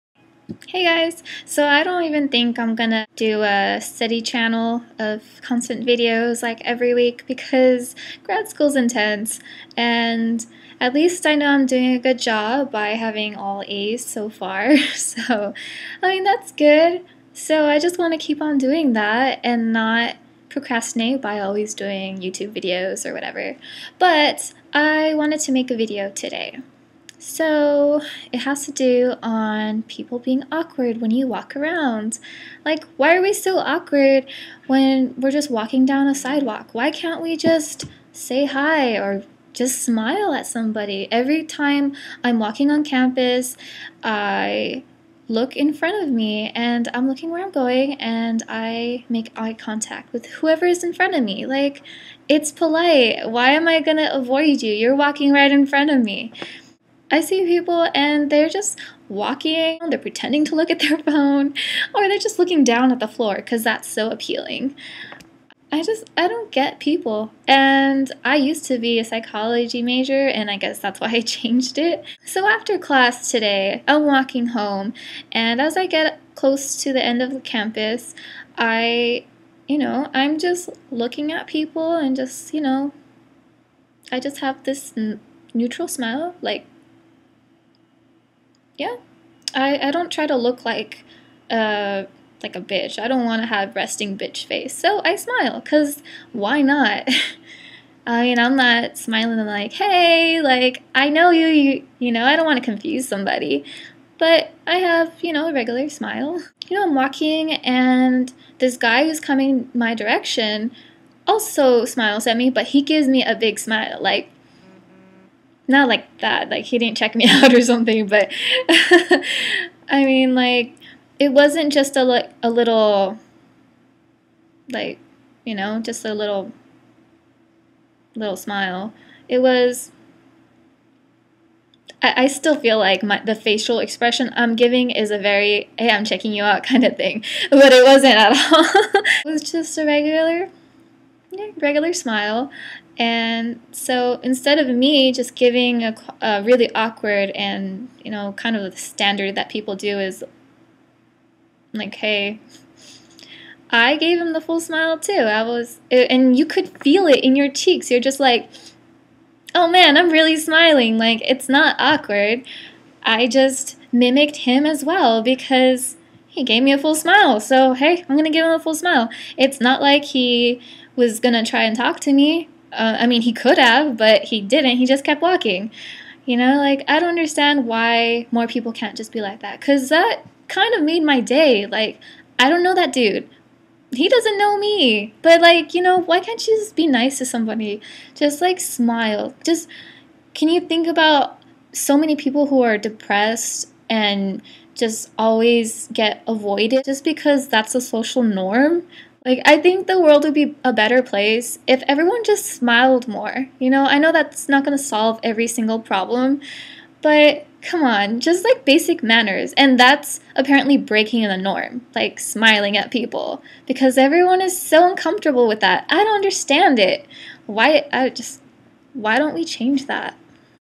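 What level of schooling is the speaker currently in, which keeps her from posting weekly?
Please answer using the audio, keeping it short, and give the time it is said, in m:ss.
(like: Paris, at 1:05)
grad school, at 0:08.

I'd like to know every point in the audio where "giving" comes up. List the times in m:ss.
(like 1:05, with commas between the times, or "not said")
2:14, 2:25.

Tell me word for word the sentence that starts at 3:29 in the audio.
And that's apparently breaking the norm, like smiling at people, because everyone is so uncomfortable with that.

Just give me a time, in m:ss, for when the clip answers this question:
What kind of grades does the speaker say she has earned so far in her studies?
0:13.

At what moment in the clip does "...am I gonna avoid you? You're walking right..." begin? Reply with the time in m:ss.
0:53.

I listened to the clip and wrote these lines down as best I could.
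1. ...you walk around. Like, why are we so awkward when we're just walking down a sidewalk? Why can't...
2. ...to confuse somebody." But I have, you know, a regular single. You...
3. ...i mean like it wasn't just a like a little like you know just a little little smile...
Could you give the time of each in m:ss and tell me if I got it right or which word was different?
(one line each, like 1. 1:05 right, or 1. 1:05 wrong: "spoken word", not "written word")
1. 0:31 right
2. 1:42 wrong: "smile", not "single"
3. 1:59 right.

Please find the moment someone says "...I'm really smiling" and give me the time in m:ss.
2:39.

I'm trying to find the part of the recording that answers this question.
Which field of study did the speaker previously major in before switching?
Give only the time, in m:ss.
1:09.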